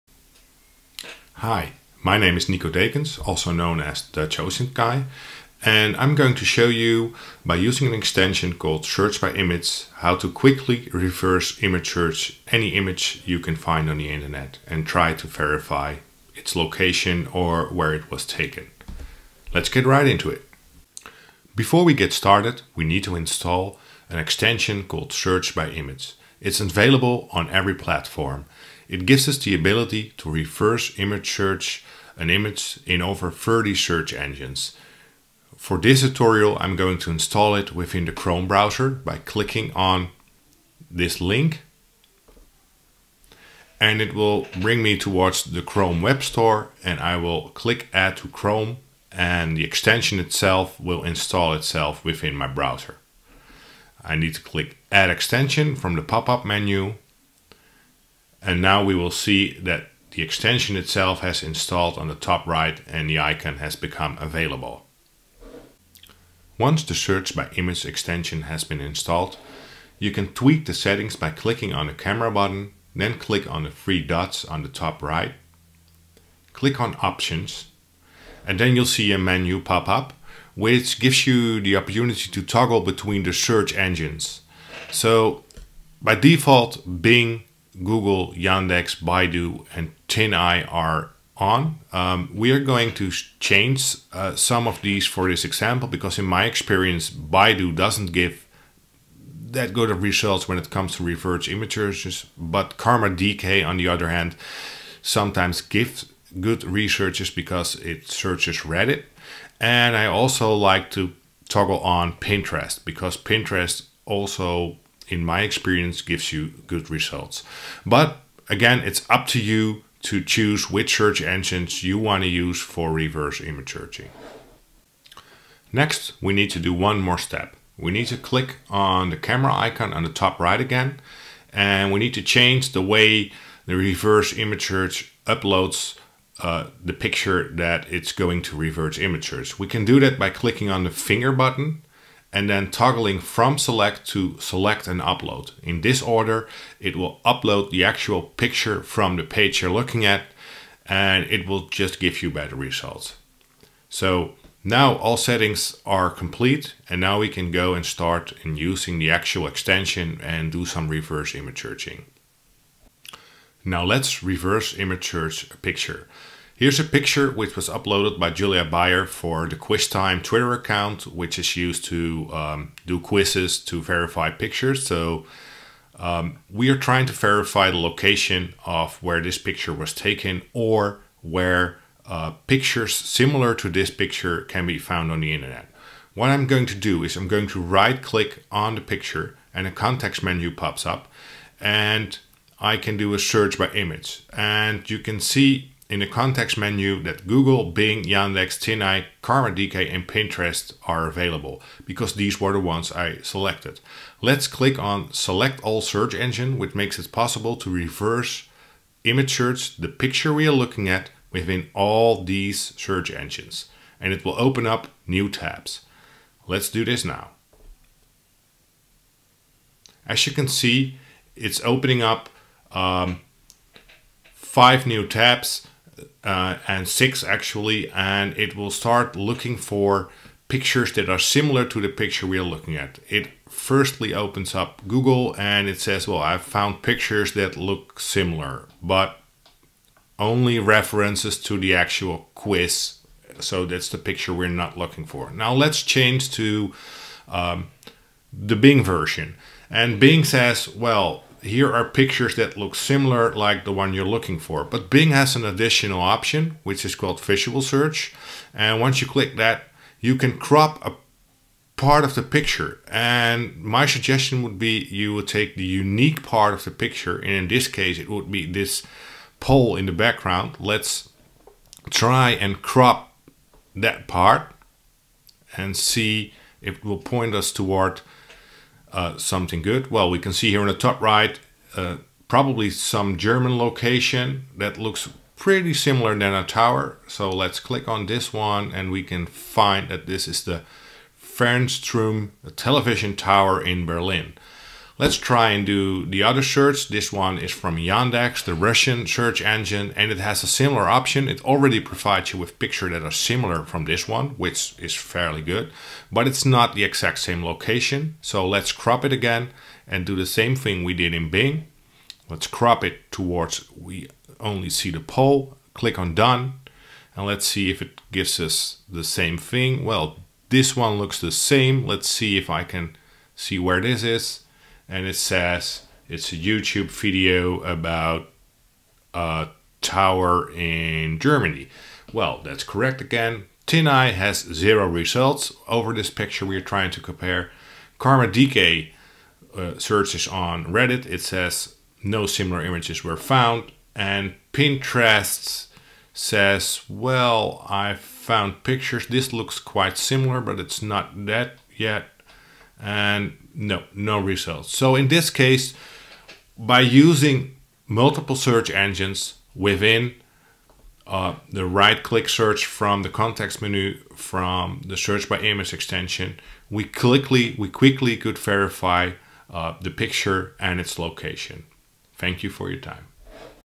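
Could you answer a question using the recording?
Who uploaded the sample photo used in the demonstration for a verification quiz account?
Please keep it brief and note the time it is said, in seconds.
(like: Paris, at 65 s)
Julia Bayer, at 168 s.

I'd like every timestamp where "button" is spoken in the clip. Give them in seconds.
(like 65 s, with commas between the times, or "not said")
72 s, 141 s.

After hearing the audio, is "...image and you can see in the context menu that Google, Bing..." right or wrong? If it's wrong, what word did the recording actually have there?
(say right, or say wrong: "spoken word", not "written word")
right.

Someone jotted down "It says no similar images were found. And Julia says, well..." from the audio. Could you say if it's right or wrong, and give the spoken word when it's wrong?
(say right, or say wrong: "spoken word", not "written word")
wrong: "Pinterest", not "Julia".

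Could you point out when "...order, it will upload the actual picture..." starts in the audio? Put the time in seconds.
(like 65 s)
146 s.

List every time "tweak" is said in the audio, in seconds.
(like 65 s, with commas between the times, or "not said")
70 s.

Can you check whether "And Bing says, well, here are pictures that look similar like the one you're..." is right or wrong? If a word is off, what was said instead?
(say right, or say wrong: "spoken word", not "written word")
right.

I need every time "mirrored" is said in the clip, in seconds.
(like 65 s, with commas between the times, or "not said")
not said.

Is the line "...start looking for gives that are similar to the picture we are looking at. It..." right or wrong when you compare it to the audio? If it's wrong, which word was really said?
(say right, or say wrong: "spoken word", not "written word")
wrong: "pictures", not "gives".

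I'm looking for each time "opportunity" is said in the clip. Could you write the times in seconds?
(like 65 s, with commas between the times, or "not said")
81 s.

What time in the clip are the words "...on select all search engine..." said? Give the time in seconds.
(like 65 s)
204 s.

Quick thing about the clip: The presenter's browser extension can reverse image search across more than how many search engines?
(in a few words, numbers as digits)
30.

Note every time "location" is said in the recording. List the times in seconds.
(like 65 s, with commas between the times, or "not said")
16 s, 177 s, 283 s, 307 s, 370 s.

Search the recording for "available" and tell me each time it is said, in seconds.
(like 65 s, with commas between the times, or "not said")
26 s, 64 s, 201 s.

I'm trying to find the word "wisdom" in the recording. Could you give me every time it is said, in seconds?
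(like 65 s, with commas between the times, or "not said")
not said.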